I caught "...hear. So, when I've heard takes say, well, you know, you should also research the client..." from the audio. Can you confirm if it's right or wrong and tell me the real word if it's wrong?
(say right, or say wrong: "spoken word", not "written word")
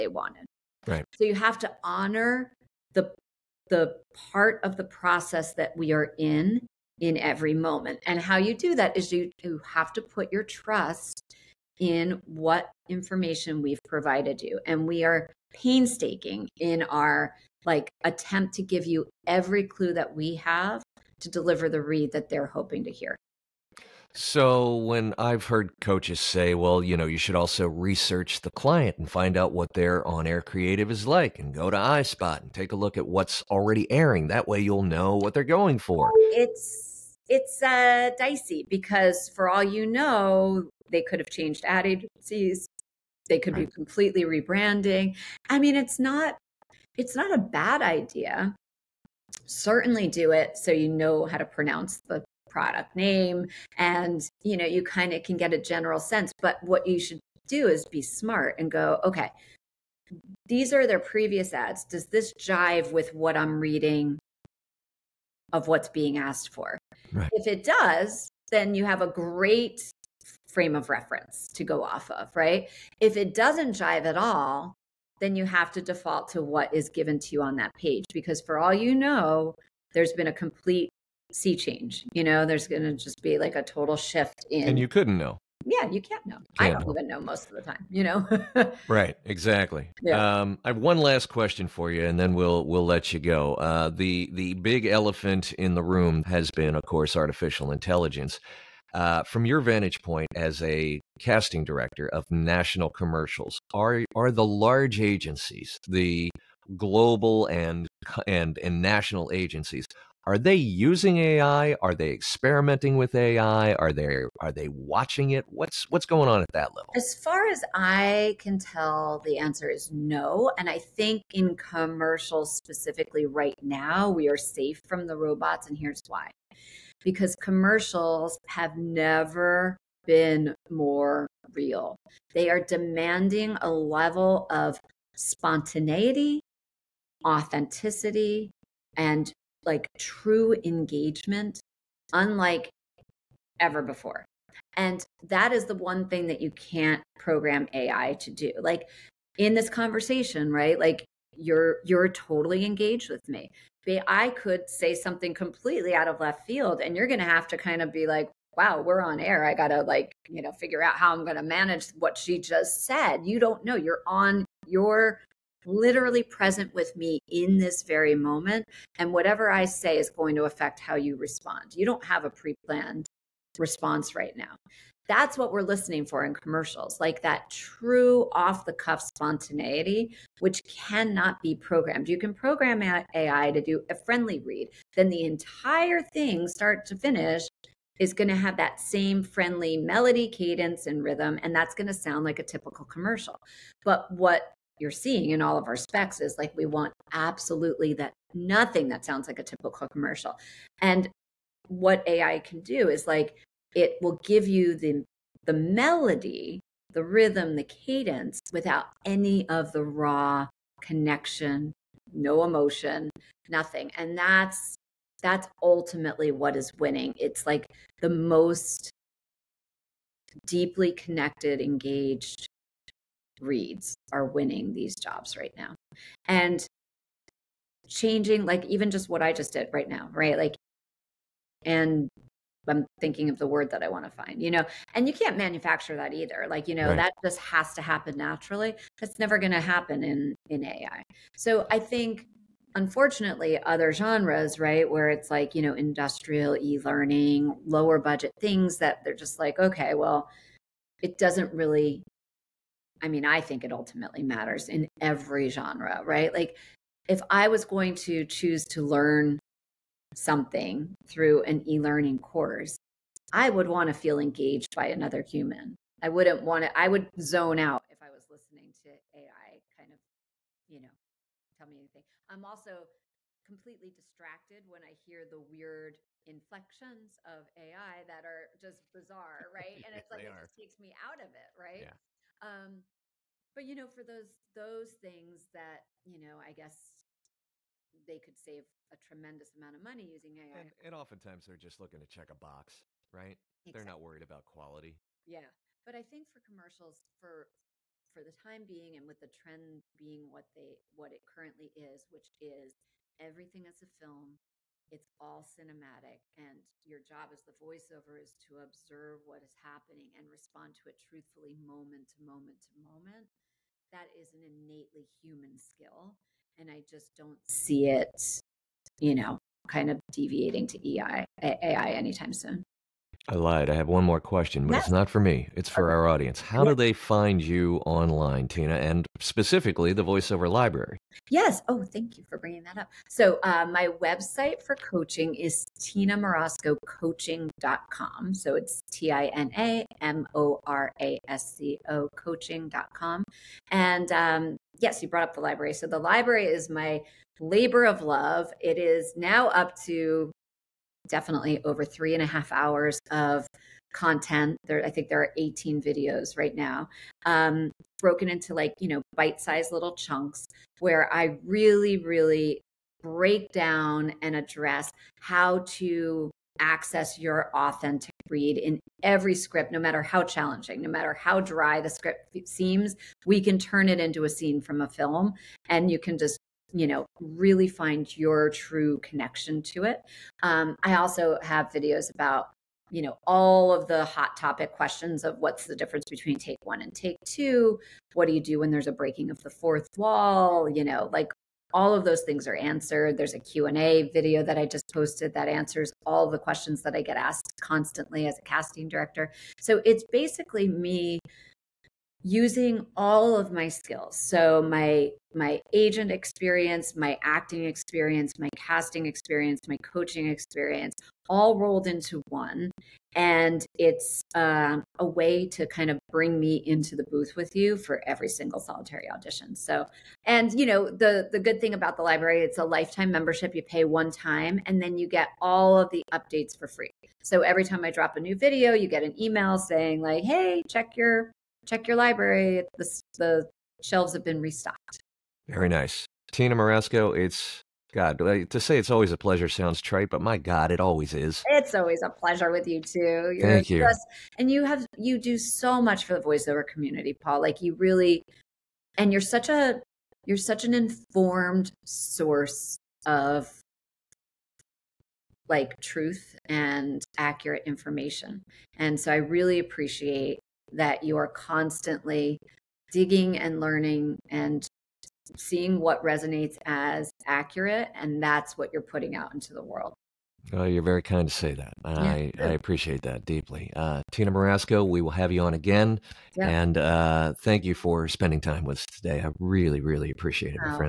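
wrong: "coaches", not "takes".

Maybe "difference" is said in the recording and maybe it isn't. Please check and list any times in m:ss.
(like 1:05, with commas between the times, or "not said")
6:25.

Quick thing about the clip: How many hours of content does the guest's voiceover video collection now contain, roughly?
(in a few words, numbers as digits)
Over 3.5 hours.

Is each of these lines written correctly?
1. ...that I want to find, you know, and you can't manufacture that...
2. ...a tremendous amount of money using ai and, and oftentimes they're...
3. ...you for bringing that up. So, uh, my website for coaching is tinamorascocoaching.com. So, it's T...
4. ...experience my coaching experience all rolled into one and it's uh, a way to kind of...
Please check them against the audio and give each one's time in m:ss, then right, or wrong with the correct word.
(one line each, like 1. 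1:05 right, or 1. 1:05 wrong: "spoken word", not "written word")
1. 3:53 right
2. 4:48 right
3. 5:32 right
4. 6:49 right.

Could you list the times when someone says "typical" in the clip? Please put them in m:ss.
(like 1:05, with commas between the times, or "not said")
3:12, 3:19.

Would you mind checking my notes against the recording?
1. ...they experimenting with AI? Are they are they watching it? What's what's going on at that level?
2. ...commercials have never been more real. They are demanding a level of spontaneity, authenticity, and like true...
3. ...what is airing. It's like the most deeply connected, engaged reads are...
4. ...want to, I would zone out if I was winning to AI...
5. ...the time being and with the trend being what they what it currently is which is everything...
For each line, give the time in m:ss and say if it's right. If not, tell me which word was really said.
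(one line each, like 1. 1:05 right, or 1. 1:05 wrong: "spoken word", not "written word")
1. 1:51 right
2. 2:07 right
3. 3:36 wrong: "winning", not "airing"
4. 4:26 wrong: "listening", not "winning"
5. 4:58 right.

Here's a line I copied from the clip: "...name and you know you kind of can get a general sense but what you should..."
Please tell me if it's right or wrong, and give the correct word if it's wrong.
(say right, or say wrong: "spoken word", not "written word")
right.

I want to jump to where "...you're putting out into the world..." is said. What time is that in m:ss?
7:48.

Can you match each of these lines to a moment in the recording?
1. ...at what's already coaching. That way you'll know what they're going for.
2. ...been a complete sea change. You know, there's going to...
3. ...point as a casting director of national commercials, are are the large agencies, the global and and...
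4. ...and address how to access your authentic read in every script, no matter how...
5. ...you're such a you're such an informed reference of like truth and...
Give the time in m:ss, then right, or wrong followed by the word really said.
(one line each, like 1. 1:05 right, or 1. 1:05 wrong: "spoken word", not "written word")
1. 0:32 wrong: "airing", not "coaching"
2. 1:20 right
3. 1:40 right
4. 6:04 right
5. 7:29 wrong: "source", not "reference".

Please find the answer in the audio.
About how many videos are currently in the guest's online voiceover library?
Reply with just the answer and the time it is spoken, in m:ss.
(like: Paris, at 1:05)
18, at 5:55.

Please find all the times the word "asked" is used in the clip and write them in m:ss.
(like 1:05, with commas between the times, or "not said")
1:06, 6:37.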